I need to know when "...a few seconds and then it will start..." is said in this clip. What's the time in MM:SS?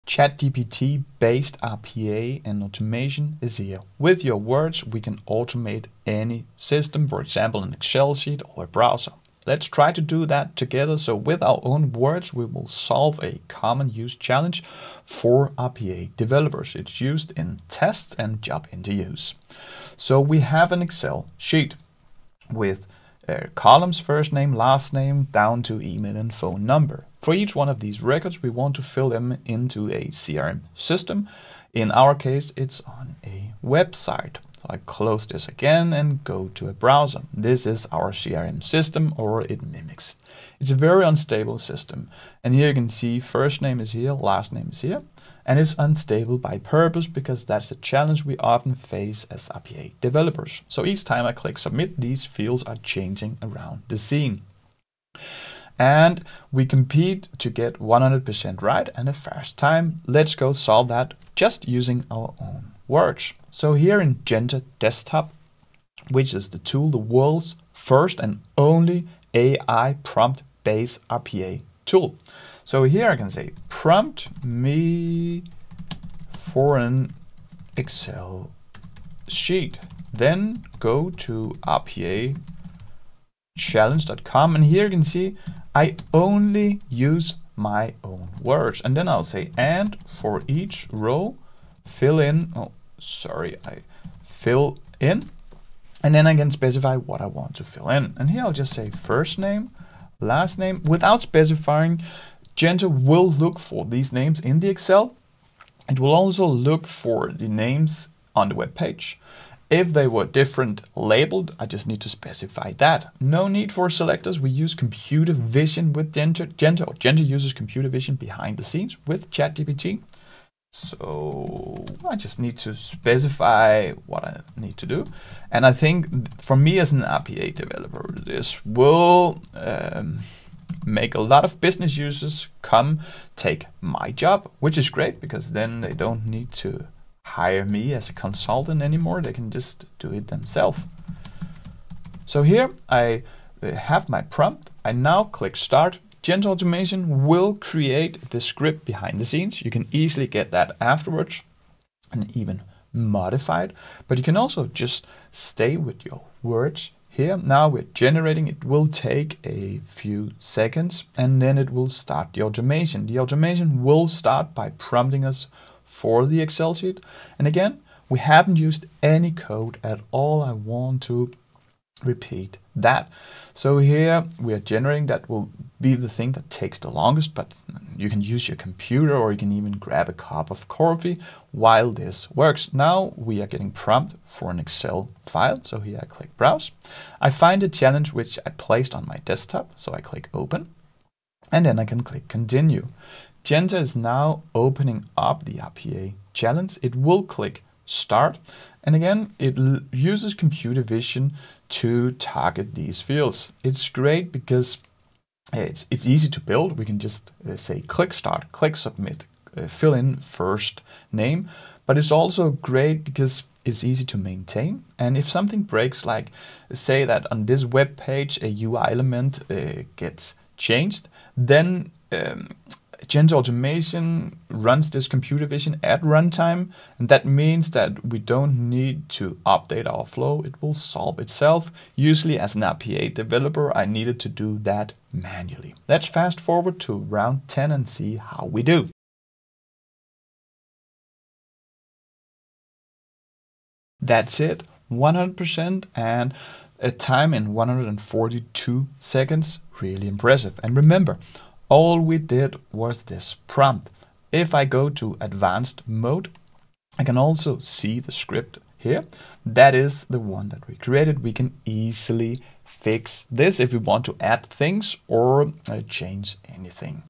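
02:39.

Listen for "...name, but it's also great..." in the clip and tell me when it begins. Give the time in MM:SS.
03:31.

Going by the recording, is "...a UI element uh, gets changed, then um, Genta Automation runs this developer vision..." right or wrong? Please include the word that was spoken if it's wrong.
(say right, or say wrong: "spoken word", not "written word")
wrong: "computer", not "developer".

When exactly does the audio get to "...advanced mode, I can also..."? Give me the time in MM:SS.
04:15.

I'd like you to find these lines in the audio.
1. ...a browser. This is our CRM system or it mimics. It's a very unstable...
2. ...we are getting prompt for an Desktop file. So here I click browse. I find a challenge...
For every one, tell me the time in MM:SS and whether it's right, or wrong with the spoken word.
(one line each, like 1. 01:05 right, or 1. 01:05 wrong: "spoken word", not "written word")
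1. 00:36 right
2. 03:03 wrong: "Excel", not "Desktop".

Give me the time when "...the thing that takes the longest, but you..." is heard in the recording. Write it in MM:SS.
02:55.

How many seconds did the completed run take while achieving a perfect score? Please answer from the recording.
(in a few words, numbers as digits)
142.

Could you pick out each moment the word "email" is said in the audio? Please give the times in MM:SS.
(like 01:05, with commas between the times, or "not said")
00:25.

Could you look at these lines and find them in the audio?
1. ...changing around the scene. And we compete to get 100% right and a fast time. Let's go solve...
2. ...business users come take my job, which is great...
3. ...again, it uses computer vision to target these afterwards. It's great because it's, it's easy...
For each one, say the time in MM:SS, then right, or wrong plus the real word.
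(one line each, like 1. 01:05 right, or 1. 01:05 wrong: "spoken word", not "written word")
1. 00:52 right
2. 02:11 right
3. 03:18 wrong: "fields", not "afterwards".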